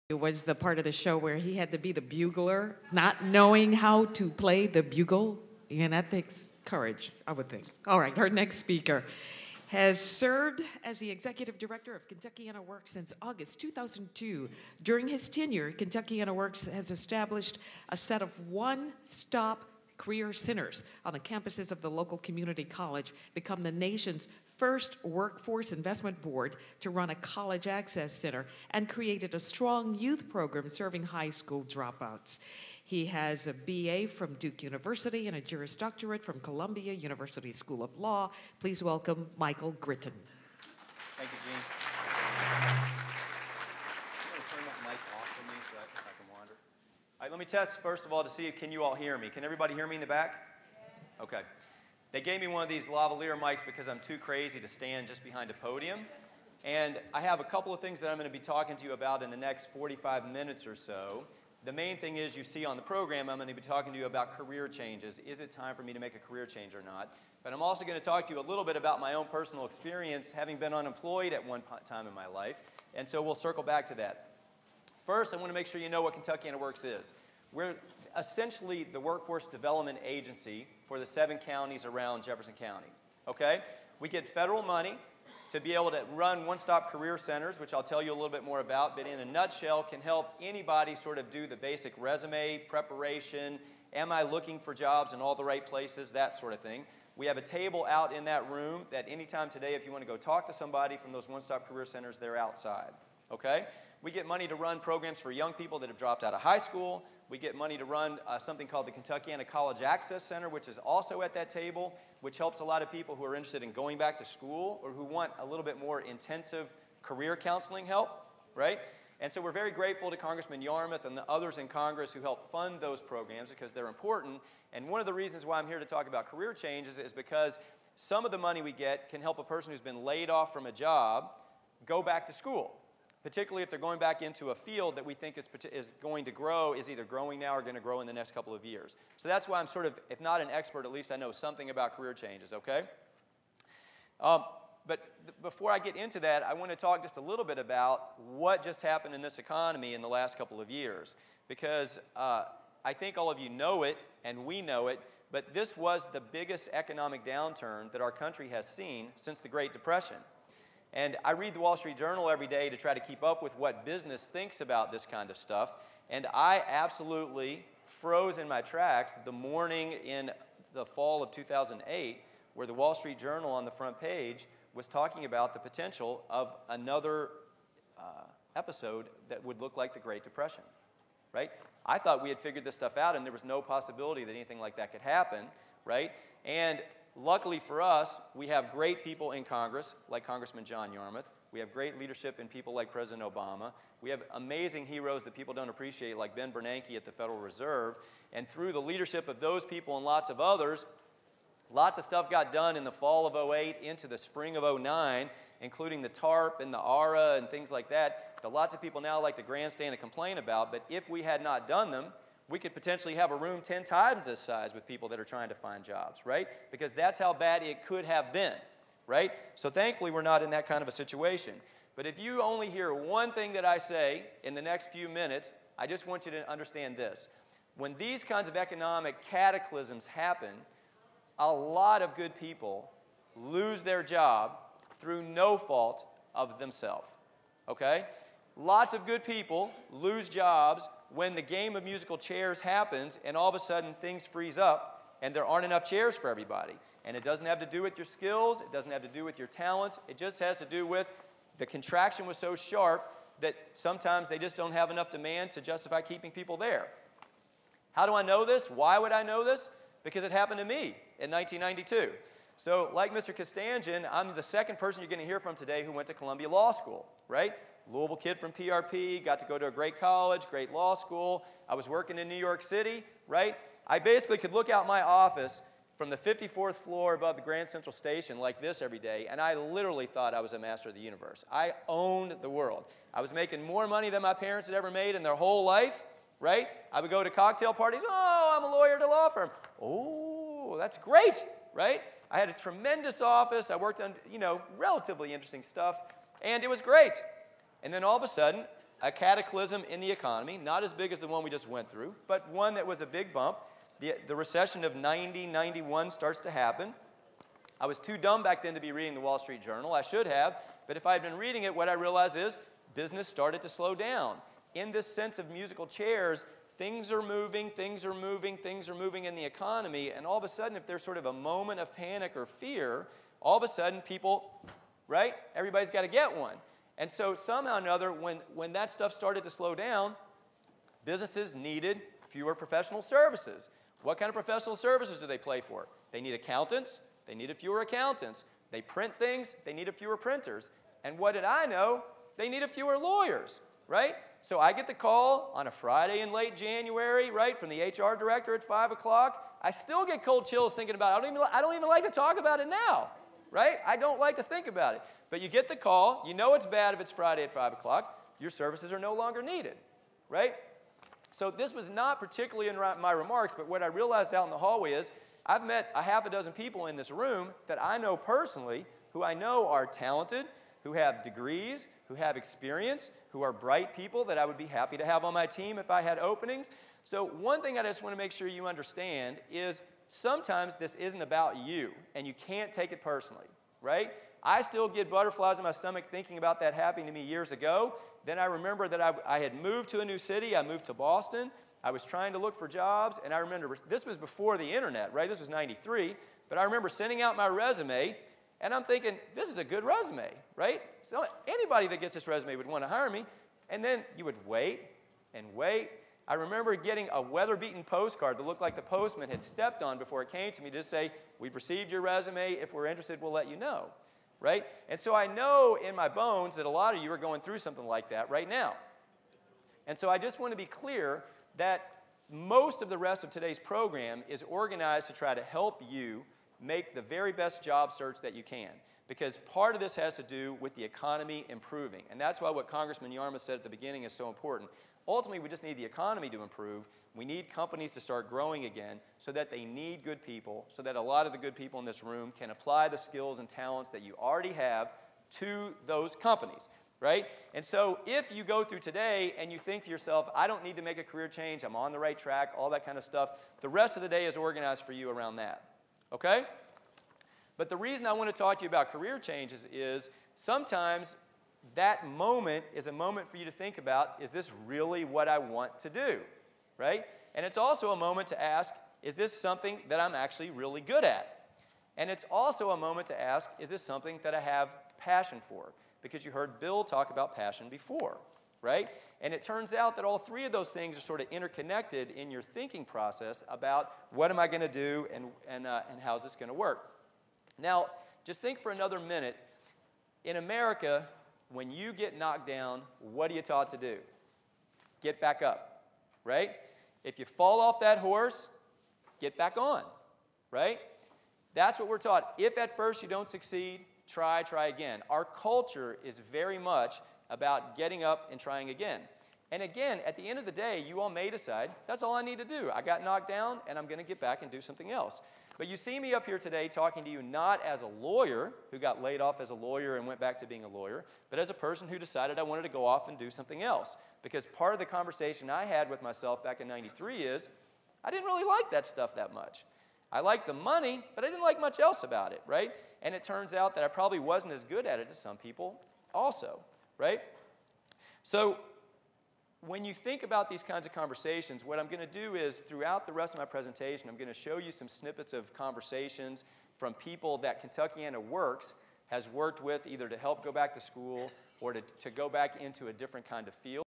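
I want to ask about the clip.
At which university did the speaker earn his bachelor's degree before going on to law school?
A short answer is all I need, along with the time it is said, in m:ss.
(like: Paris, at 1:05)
Duke University, at 0:34.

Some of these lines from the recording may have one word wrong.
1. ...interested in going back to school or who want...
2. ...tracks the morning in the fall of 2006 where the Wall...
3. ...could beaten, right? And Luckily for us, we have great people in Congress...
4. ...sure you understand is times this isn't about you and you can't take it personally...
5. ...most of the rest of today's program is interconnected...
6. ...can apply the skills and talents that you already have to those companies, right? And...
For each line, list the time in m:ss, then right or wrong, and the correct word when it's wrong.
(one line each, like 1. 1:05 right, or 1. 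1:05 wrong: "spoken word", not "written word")
1. 1:53 right
2. 2:48 wrong: "2008", not "2006"
3. 3:04 wrong: "happen", not "beaten"
4. 6:18 wrong: "sometimes", not "times"
5. 7:02 wrong: "organized", not "interconnected"
6. 7:22 right.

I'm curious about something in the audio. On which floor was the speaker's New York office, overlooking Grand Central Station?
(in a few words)
54th floor.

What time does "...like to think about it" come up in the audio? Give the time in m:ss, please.
5:54.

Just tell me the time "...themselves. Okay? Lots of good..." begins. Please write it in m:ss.
3:56.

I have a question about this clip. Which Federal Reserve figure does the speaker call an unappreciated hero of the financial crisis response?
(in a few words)
Ben Bernanke.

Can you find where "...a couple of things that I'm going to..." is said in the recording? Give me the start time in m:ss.
0:57.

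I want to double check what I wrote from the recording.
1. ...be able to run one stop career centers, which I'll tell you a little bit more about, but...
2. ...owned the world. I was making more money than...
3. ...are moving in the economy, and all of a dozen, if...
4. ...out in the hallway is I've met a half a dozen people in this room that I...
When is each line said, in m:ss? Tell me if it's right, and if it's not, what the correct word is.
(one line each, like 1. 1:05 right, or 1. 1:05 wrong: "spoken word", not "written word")
1. 1:25 right
2. 4:41 right
3. 5:18 wrong: "sudden", not "dozen"
4. 6:04 right.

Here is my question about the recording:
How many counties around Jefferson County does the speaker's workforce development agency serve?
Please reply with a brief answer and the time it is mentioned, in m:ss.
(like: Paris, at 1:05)
7, at 1:21.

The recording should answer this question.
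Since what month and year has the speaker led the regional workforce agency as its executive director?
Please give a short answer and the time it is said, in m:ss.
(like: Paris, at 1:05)
August 2002, at 0:13.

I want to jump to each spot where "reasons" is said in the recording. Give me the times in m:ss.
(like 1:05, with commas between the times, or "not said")
2:05, 7:37.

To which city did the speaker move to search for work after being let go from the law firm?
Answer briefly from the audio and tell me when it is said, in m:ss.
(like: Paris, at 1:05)
Boston, at 6:30.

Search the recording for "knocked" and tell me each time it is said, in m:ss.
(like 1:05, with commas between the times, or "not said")
8:12, 8:33.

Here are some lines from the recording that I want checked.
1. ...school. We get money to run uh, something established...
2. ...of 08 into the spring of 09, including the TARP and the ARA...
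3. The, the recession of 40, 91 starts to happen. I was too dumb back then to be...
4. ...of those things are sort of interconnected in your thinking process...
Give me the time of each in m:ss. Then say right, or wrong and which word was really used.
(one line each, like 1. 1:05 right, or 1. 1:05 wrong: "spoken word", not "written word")
1. 1:46 wrong: "called", not "established"
2. 3:23 right
3. 5:03 wrong: "90", not "40"
4. 8:00 right.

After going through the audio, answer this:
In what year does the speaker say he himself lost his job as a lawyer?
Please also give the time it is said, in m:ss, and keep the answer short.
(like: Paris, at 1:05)
1992, at 4:21.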